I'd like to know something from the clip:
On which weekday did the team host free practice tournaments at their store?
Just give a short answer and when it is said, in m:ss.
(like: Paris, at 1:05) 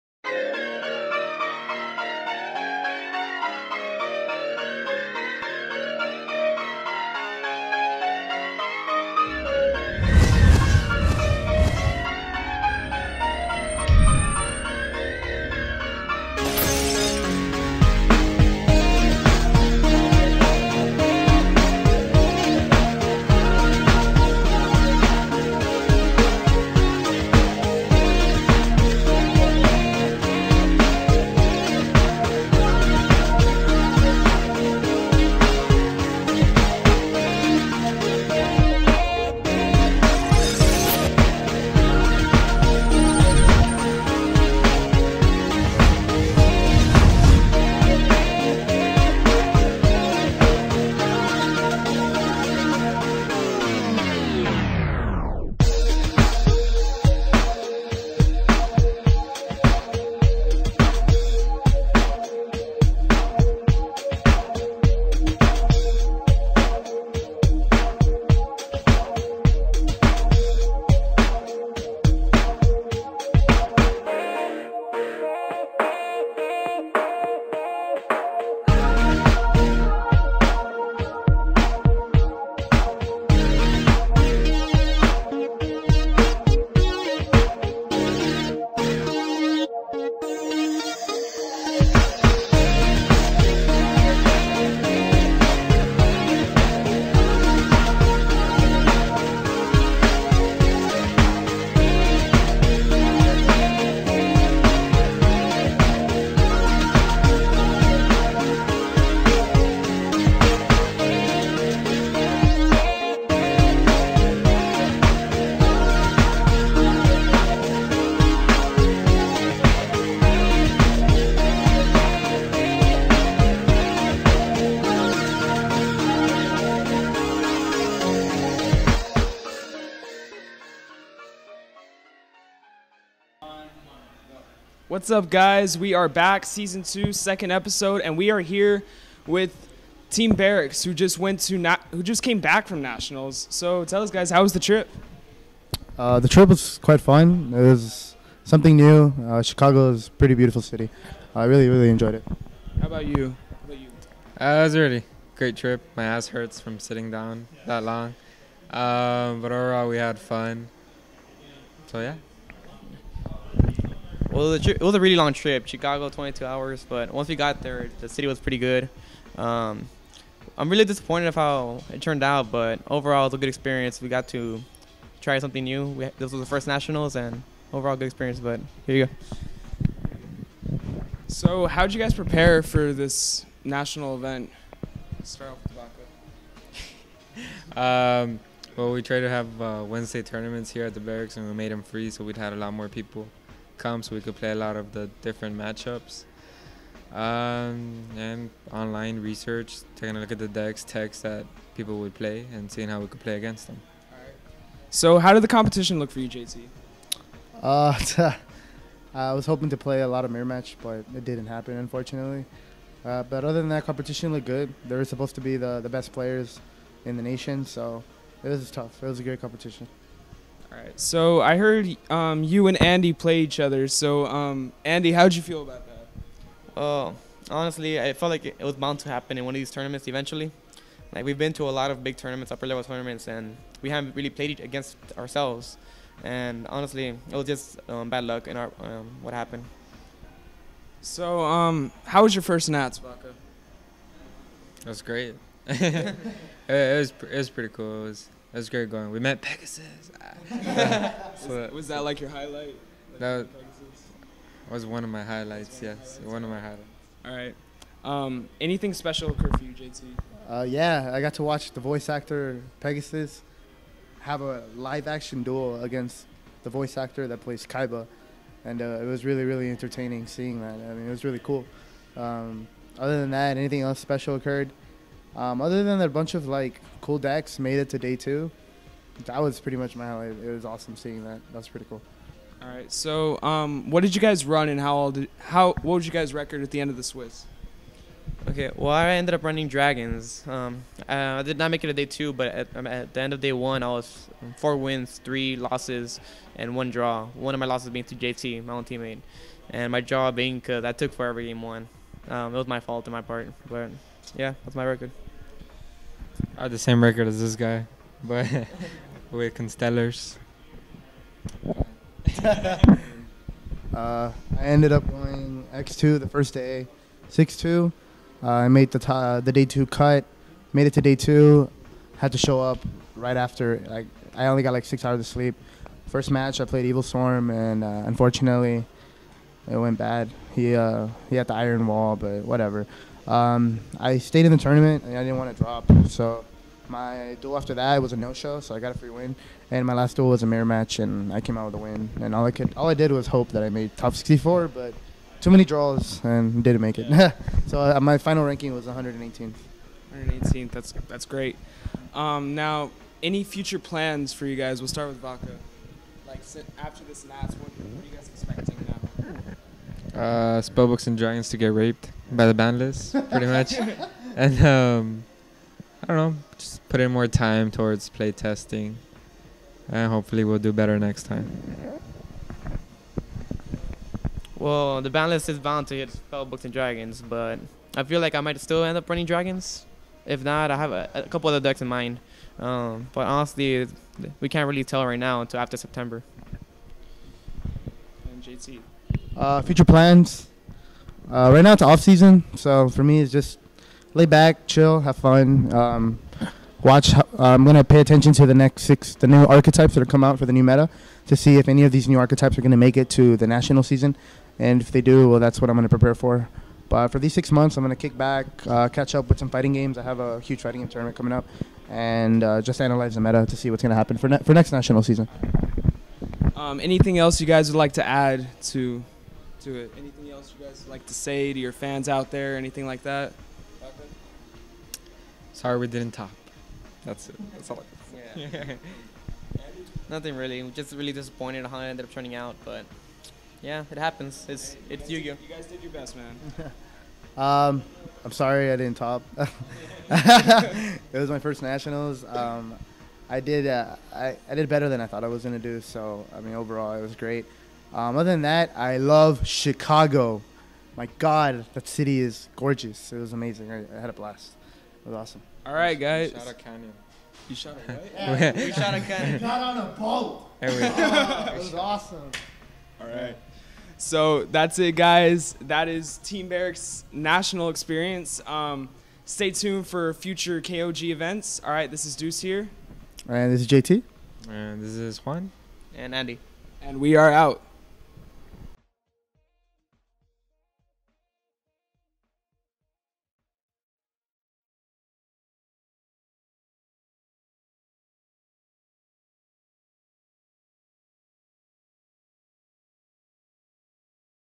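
Wednesday, at 3:09.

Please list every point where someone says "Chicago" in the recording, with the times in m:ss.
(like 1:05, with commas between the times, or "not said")
2:29, 2:45, 7:29.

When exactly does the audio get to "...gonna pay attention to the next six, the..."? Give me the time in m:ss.
6:37.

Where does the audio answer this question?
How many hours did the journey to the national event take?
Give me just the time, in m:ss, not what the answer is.
2:46.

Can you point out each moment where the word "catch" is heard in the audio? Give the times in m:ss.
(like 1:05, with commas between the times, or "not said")
6:48.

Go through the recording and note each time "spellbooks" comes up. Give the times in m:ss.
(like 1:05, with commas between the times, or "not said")
6:00, 6:16.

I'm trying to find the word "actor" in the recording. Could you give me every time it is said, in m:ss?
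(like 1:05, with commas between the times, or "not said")
4:22, 4:26.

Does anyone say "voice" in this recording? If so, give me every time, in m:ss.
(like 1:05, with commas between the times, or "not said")
4:21, 4:26.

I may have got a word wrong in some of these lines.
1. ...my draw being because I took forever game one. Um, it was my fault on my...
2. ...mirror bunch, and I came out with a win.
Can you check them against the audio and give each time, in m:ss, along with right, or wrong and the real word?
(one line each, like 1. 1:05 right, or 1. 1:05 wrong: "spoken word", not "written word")
1. 4:59 right
2. 5:40 wrong: "match", not "bunch".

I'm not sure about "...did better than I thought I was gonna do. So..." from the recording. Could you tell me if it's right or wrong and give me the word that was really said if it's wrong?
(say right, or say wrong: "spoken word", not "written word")
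right.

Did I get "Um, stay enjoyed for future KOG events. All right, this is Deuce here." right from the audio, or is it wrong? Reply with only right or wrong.
wrong.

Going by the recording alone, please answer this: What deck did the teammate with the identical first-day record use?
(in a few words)
Constellars.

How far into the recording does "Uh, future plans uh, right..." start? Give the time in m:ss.
6:29.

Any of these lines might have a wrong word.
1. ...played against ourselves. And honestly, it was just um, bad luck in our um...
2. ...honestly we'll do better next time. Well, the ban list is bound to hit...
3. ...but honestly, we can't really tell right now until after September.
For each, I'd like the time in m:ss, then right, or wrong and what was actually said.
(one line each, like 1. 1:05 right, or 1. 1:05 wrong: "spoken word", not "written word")
1. 3:54 right
2. 6:10 wrong: "hopefully", not "honestly"
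3. 6:23 right.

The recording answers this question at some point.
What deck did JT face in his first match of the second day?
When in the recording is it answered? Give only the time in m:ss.
5:26.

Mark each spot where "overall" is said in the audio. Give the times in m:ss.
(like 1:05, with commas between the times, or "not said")
2:39, 2:52, 2:57, 7:26.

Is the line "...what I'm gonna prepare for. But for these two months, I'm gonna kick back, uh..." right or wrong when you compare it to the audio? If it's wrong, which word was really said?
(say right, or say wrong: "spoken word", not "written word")
wrong: "six", not "two".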